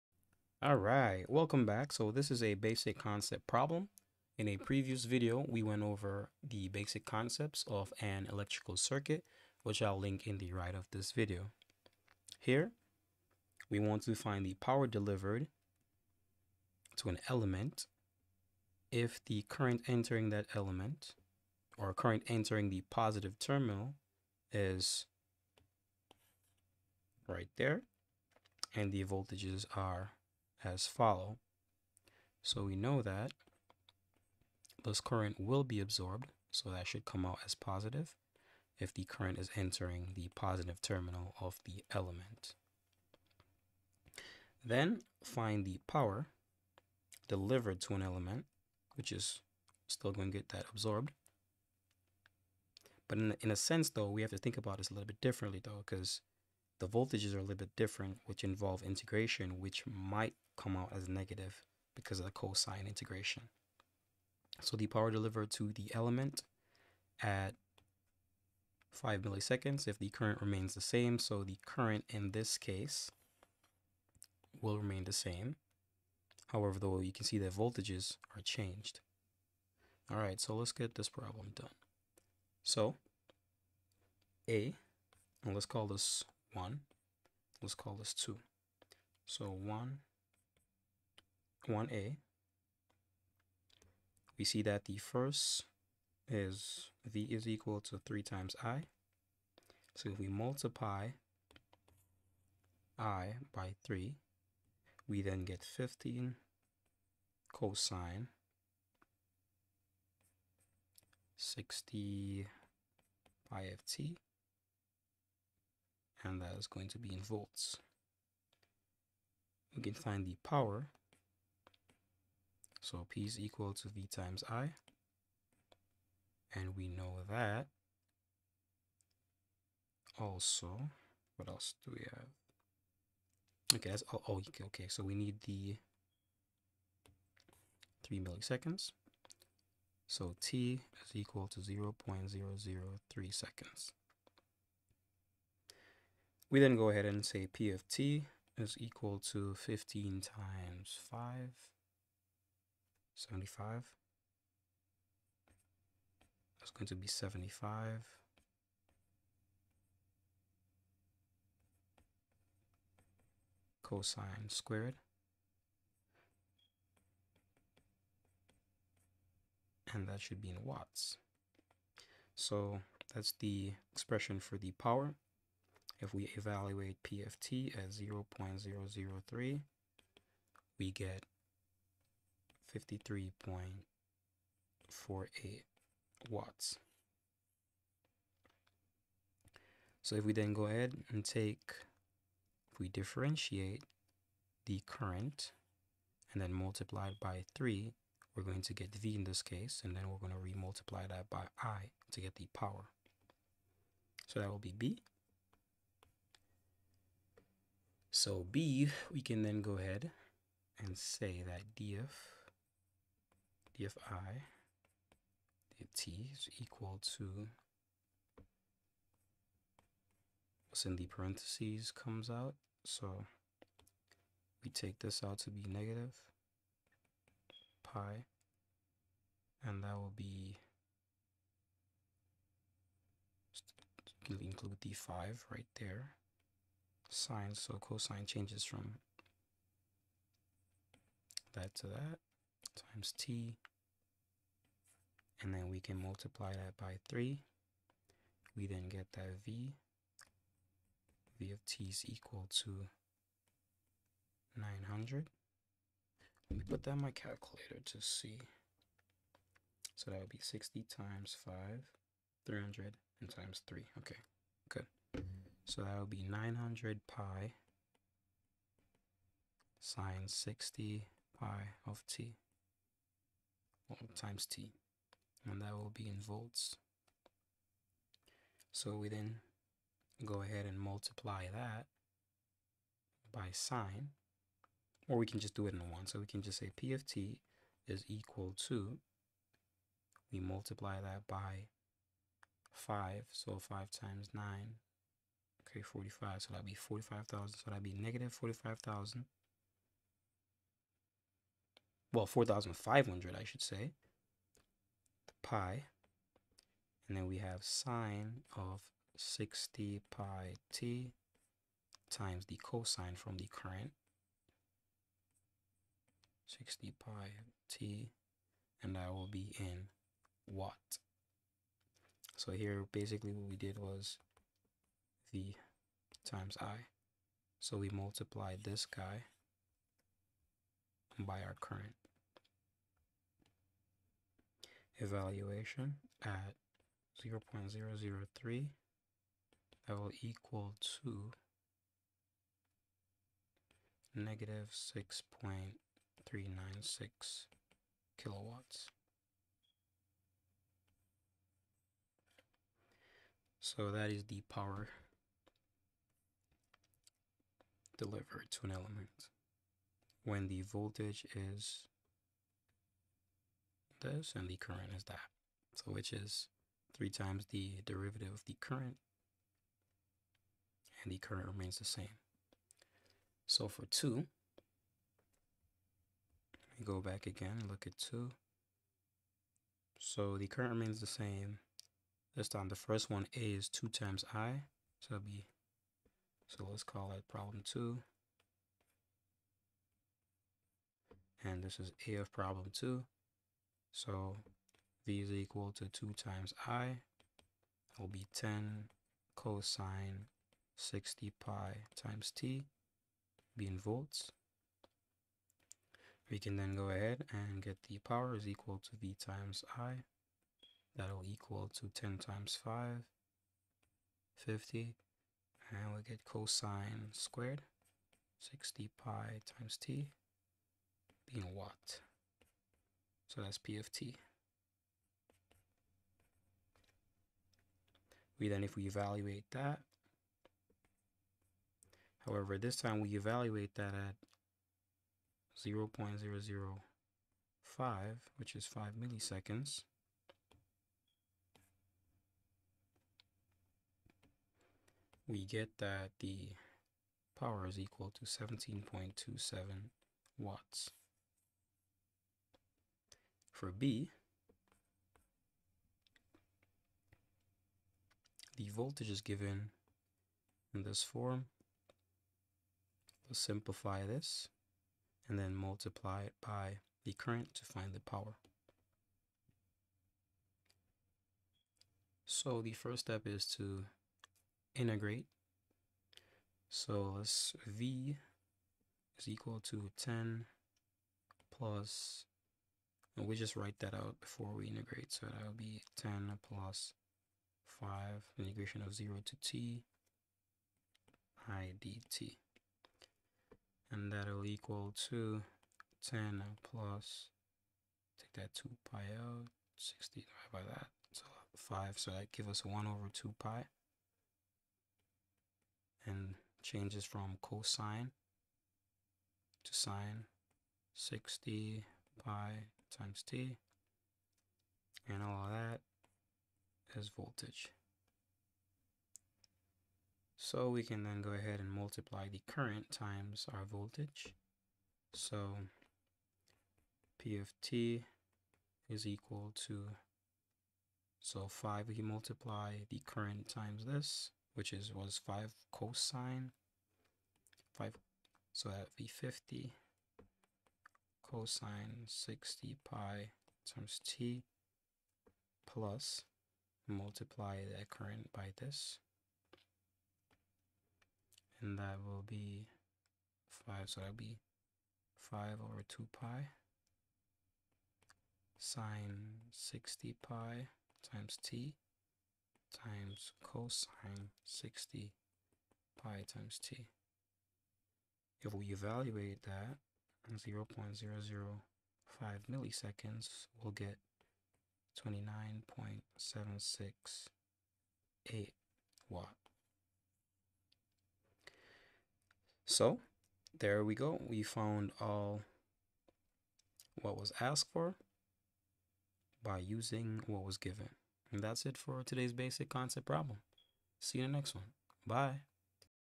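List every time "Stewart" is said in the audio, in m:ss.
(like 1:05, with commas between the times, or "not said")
not said.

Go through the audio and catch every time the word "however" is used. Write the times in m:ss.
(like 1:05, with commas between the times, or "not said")
1:16, 7:12.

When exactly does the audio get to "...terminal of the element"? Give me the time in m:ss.
0:40.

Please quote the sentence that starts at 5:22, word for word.
So here basically what we did was the times i.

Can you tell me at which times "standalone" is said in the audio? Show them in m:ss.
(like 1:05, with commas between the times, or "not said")
not said.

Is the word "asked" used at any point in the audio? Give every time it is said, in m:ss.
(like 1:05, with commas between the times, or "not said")
9:47.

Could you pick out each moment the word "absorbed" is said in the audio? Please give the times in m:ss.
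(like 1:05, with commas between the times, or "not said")
0:35, 0:50.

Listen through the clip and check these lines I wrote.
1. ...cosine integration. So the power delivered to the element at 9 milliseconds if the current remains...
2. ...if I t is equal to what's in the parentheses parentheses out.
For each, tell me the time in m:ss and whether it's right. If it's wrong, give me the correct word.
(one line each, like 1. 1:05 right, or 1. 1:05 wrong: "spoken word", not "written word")
1. 1:02 wrong: "5", not "9"
2. 3:33 wrong: "comes", not "parentheses".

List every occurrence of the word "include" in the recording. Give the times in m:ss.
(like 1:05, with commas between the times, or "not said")
3:54.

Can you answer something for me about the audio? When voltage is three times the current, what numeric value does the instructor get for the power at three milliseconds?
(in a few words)
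53.48 watts.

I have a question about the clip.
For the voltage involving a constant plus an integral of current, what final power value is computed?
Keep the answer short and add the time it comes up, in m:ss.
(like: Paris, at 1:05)
29.768 watts, at 9:35.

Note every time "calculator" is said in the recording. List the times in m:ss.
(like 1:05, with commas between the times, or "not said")
4:17.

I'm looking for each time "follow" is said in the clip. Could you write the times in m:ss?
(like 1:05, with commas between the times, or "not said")
0:30.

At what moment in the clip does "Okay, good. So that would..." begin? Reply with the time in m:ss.
4:23.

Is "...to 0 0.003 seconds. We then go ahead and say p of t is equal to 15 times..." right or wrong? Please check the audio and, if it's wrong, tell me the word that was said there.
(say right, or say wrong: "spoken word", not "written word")
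right.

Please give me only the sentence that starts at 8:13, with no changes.
And that'll equal to 10 plus, take that 2 pi out, 60 divided by that, so 5.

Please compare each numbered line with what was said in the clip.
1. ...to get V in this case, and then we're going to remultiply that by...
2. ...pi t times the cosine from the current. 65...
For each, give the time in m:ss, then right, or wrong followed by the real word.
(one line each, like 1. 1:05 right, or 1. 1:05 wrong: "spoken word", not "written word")
1. 3:18 right
2. 5:10 wrong: "60", not "65".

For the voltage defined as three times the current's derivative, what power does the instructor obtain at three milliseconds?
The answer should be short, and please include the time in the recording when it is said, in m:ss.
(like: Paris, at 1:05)
-6.396 kilowatts, at 5:44.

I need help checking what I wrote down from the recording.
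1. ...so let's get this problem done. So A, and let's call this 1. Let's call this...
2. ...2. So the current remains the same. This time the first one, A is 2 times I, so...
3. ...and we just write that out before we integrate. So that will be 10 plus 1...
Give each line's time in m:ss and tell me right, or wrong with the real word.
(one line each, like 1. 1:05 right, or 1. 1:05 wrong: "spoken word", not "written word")
1. 1:20 right
2. 6:17 right
3. 8:03 wrong: "5", not "1".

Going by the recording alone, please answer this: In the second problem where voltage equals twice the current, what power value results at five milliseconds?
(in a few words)
17.27 watts.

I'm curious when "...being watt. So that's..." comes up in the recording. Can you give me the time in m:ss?
7:01.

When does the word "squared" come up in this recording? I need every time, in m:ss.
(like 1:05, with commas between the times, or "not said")
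2:44, 6:57.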